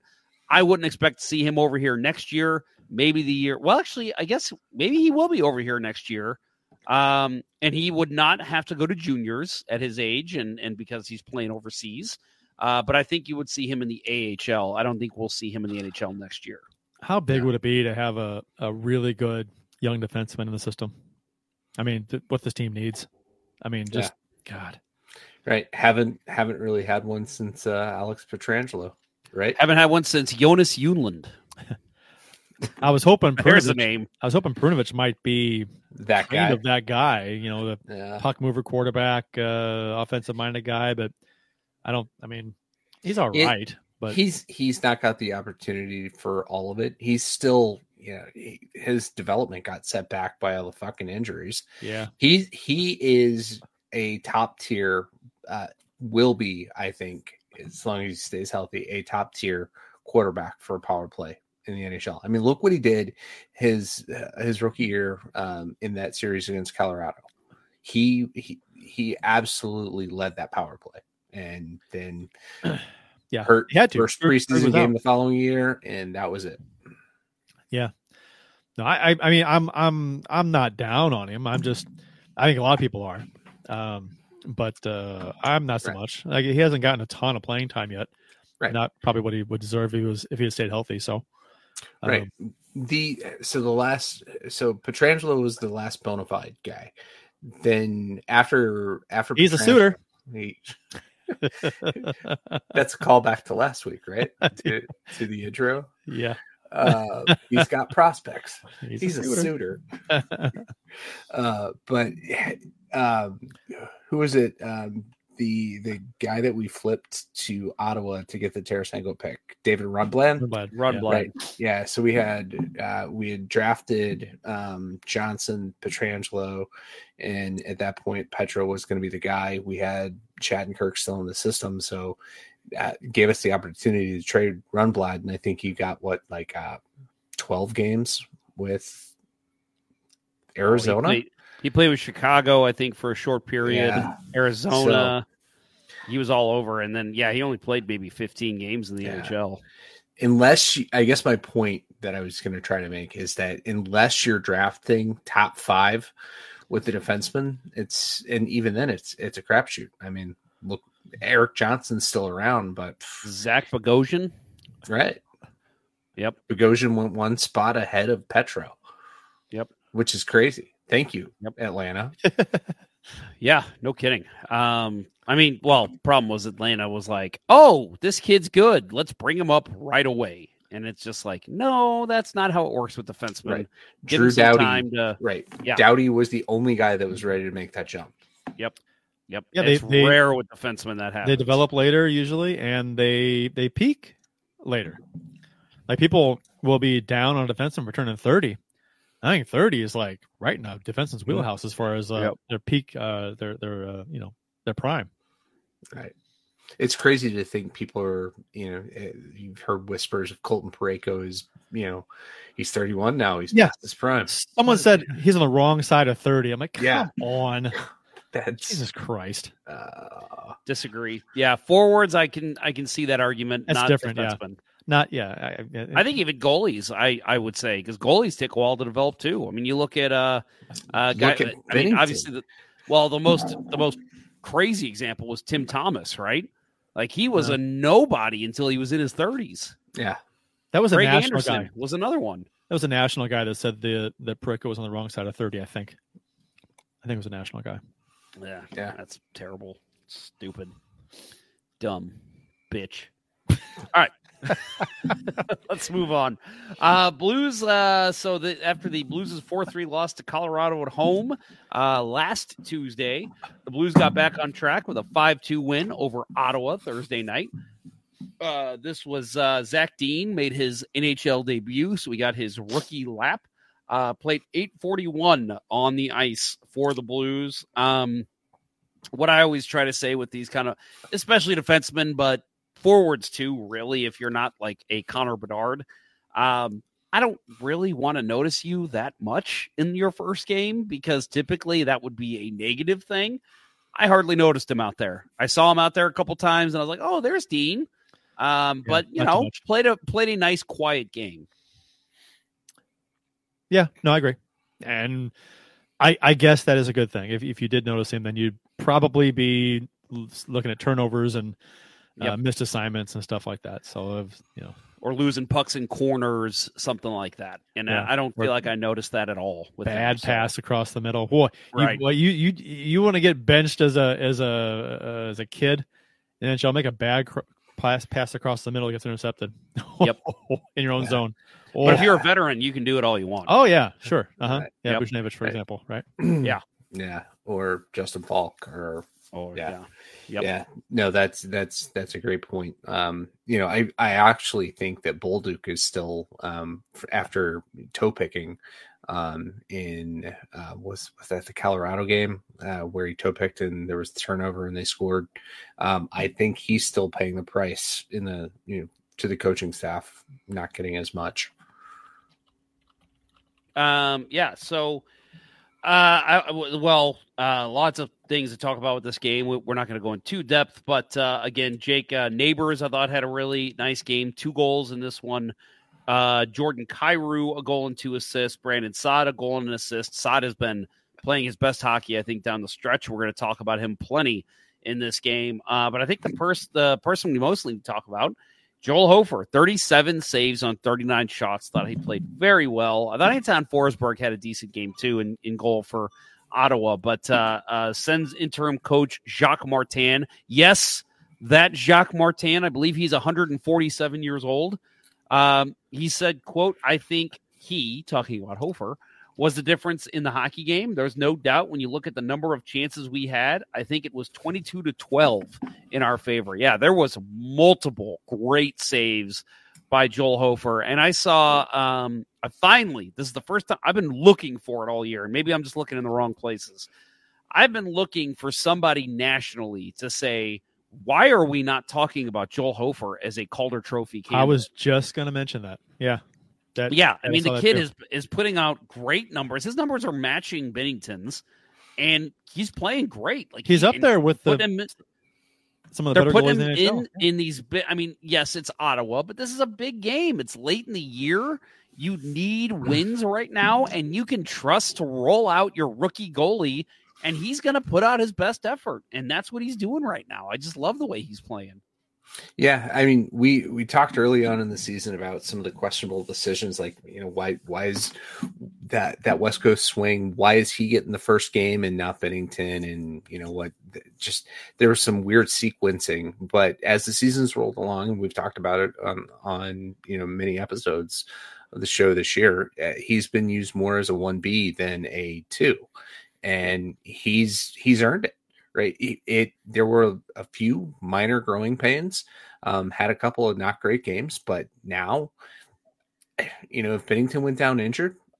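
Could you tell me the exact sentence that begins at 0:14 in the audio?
I don't think we'll see him in the NHL next year.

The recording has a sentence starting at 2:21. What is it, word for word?
Oh, he, played, he, played, with Chicago, I think, for a short period.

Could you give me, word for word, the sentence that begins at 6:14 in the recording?
Two goals in this one uh, Jordan Kyrou, a goal and two assists.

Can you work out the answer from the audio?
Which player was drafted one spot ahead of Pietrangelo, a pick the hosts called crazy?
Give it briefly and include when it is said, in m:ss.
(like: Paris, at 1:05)
Zach Bogosian, at 2:43.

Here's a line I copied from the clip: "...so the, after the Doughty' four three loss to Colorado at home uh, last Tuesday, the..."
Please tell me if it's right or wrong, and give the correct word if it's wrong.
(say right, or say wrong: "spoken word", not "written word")
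wrong: "Blues", not "Doughty".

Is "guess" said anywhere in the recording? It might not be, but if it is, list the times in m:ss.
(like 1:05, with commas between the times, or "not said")
0:04, 2:31, 5:06.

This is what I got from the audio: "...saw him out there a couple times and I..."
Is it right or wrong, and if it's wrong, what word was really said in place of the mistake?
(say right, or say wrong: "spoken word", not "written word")
right.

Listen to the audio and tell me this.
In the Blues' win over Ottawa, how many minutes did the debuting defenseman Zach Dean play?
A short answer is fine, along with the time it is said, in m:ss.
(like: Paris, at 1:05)
8:41, at 4:34.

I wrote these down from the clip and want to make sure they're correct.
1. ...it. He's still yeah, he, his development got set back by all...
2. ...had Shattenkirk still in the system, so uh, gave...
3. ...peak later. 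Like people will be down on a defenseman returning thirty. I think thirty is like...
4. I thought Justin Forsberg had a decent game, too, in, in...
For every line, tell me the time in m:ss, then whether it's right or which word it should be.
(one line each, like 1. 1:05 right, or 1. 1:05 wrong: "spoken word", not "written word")
1. 0:46 right
2. 2:09 right
3. 3:13 right
4. 6:33 wrong: "Anton", not "Justin".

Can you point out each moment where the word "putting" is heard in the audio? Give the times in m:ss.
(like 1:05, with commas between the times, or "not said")
7:18, 7:26.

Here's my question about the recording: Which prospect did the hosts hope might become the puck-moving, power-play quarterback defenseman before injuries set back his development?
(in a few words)
Perunovich.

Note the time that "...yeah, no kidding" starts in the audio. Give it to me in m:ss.
2:53.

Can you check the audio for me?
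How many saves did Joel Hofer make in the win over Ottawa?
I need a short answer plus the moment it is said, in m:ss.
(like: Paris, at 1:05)
37, at 6:29.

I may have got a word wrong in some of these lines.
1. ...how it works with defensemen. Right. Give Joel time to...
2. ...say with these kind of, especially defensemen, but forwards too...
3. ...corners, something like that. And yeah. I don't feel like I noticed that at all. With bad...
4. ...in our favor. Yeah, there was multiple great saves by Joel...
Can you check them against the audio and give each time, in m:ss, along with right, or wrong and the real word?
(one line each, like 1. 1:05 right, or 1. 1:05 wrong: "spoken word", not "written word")
1. 3:02 wrong: "Drew", not "Joel"
2. 4:39 right
3. 5:15 right
4. 6:55 right.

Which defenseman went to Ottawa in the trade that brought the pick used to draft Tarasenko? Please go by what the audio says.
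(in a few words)
David Rundblad.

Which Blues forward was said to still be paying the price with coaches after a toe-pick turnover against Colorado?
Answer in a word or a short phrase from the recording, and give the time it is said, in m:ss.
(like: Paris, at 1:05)
Bolduc, at 5:45.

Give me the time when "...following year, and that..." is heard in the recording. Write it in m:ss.
1:14.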